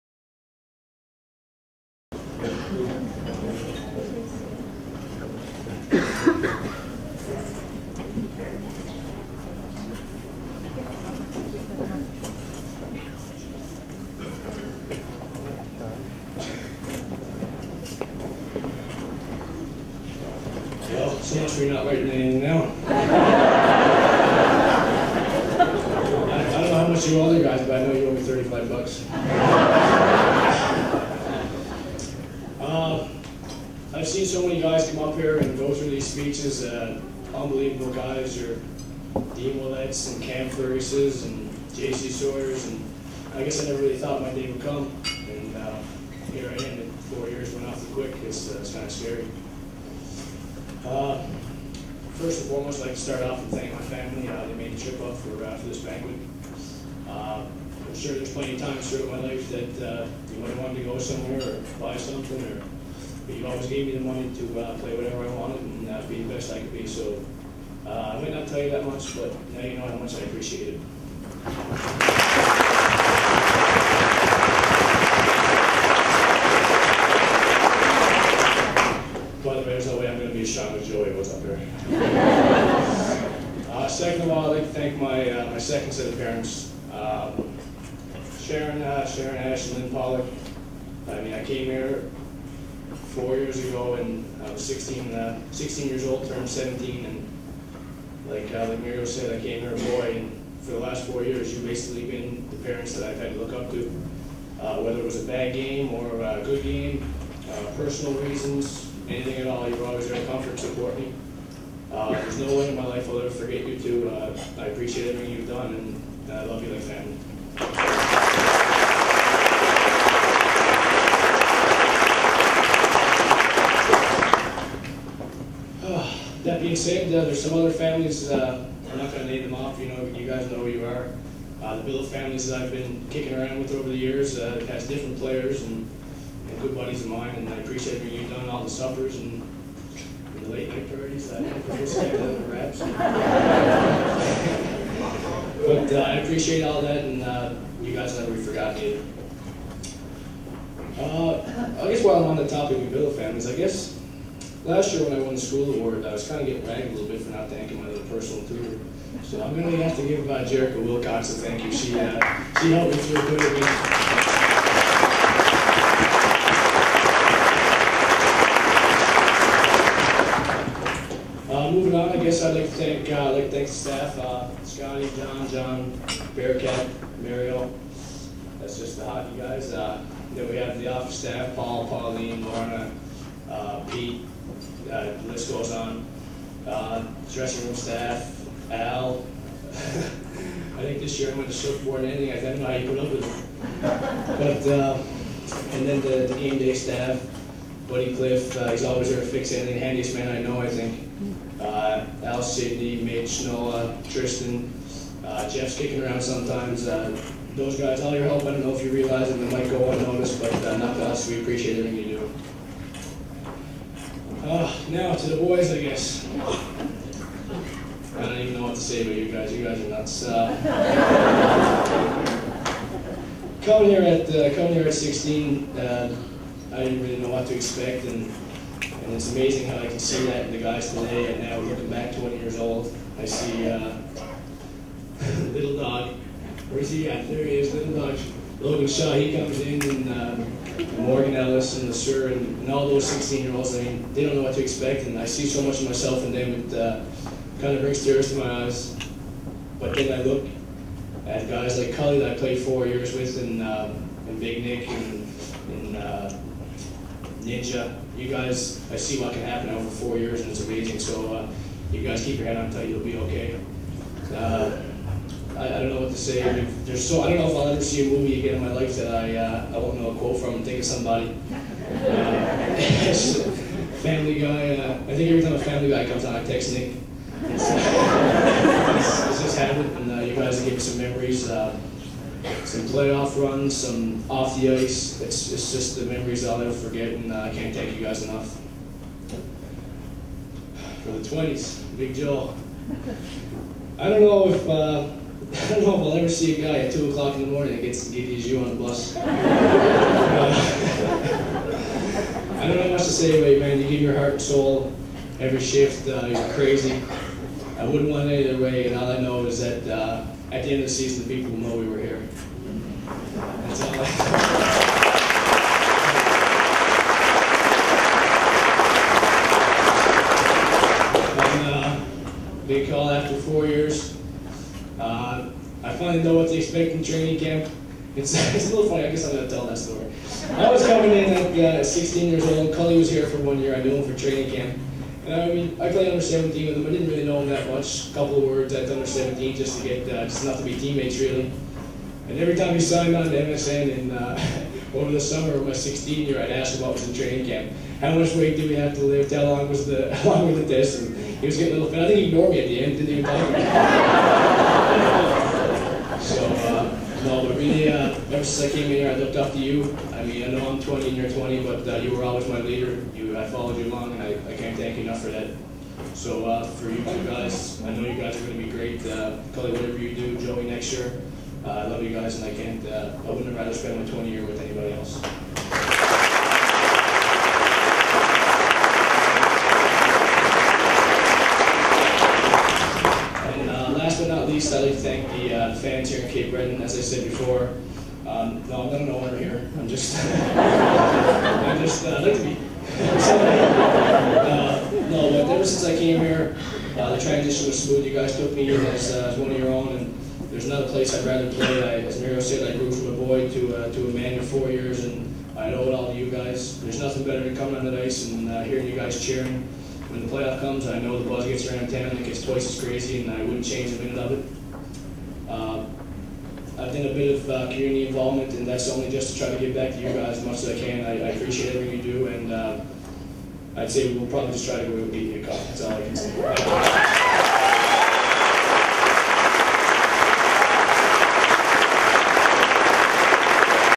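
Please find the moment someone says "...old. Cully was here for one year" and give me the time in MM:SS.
05:32.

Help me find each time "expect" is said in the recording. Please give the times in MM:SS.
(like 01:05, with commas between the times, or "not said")
03:47, 04:04, 05:26.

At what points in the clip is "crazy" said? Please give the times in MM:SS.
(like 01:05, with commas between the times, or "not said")
05:06, 06:52.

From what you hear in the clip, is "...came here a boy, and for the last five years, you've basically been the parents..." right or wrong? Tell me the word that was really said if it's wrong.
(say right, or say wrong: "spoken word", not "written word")
wrong: "four", not "five".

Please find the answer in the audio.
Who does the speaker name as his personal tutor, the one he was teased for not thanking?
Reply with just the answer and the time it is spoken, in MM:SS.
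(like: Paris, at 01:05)
Jerica Wilcox, at 02:40.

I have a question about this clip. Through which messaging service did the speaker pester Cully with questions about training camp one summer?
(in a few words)
MSN.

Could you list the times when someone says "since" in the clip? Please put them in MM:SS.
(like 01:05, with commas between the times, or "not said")
00:05, 05:58, 06:35.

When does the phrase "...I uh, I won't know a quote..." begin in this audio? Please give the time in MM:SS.
04:29.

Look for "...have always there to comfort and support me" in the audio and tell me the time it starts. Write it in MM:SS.
01:49.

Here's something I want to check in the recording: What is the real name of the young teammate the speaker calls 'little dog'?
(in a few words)
Logan Shaw.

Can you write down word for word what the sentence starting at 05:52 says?
I think he ignored me at the end.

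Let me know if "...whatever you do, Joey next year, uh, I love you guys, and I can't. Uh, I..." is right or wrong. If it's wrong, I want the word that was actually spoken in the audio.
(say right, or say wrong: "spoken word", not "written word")
right.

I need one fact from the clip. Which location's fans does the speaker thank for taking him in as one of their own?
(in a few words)
Cape Breton.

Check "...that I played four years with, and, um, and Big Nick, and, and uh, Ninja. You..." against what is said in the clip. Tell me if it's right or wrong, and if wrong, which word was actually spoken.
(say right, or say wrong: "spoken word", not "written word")
right.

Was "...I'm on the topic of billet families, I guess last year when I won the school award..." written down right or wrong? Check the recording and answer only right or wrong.
right.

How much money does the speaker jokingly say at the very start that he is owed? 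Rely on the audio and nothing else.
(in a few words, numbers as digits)
$35.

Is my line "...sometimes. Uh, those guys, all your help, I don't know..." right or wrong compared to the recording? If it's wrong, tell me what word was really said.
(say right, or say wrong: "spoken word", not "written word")
right.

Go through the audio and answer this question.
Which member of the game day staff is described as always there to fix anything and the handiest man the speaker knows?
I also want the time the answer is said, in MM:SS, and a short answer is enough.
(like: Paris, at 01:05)
Buddy Cliff, at 03:17.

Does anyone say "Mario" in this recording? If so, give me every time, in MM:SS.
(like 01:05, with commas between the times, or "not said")
02:57, 06:42.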